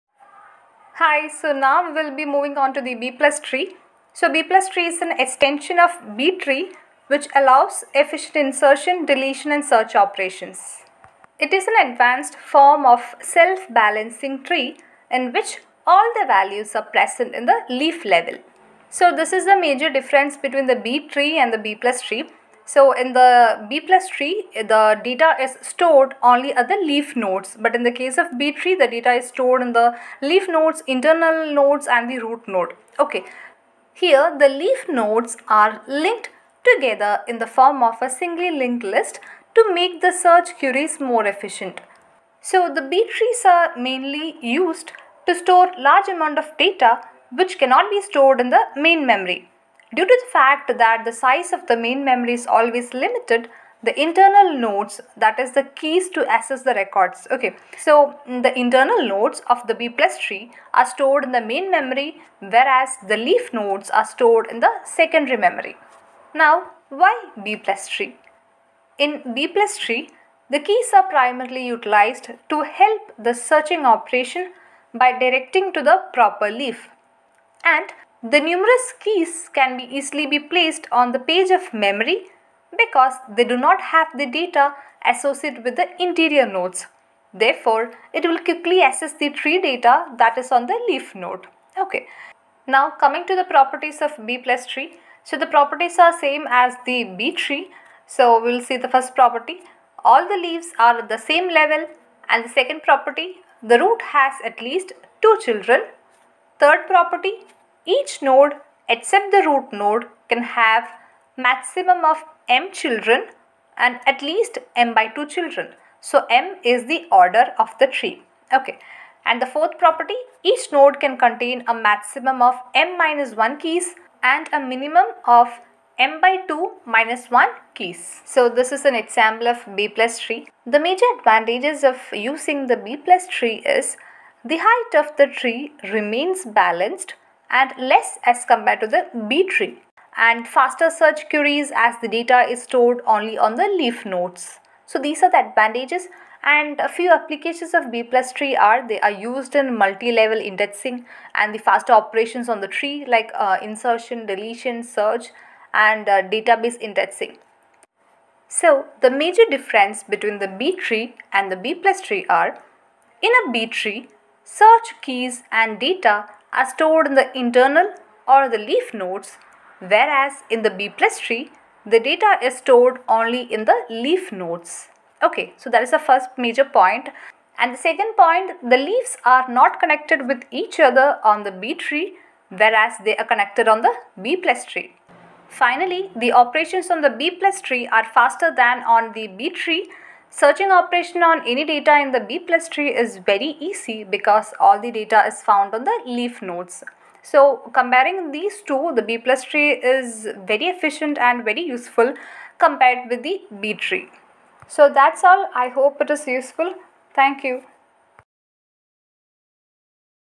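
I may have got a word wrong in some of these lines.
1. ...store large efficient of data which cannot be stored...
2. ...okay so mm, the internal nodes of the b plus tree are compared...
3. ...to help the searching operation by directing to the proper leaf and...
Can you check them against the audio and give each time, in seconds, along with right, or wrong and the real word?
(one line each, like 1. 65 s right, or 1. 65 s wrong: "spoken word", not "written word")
1. 45 s wrong: "amount", not "efficient"
2. 57 s wrong: "stored", not "compared"
3. 72 s right.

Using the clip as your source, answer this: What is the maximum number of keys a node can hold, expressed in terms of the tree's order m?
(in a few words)
m minus 1.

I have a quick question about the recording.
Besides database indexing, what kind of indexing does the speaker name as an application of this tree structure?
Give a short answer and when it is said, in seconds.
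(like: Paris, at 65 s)
multi-level indexing, at 149 s.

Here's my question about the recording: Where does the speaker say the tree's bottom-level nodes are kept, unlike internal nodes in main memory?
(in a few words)
secondary memory.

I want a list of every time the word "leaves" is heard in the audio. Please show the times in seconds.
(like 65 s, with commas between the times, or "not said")
100 s, 178 s.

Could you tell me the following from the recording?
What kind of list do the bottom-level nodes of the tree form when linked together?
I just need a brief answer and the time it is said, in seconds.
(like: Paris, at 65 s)
singly linked list, at 38 s.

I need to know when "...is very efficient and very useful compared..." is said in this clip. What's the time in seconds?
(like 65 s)
199 s.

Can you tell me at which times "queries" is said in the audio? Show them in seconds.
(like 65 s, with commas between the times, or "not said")
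40 s, 141 s.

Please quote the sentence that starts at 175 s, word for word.
Okay, so that is the first major point.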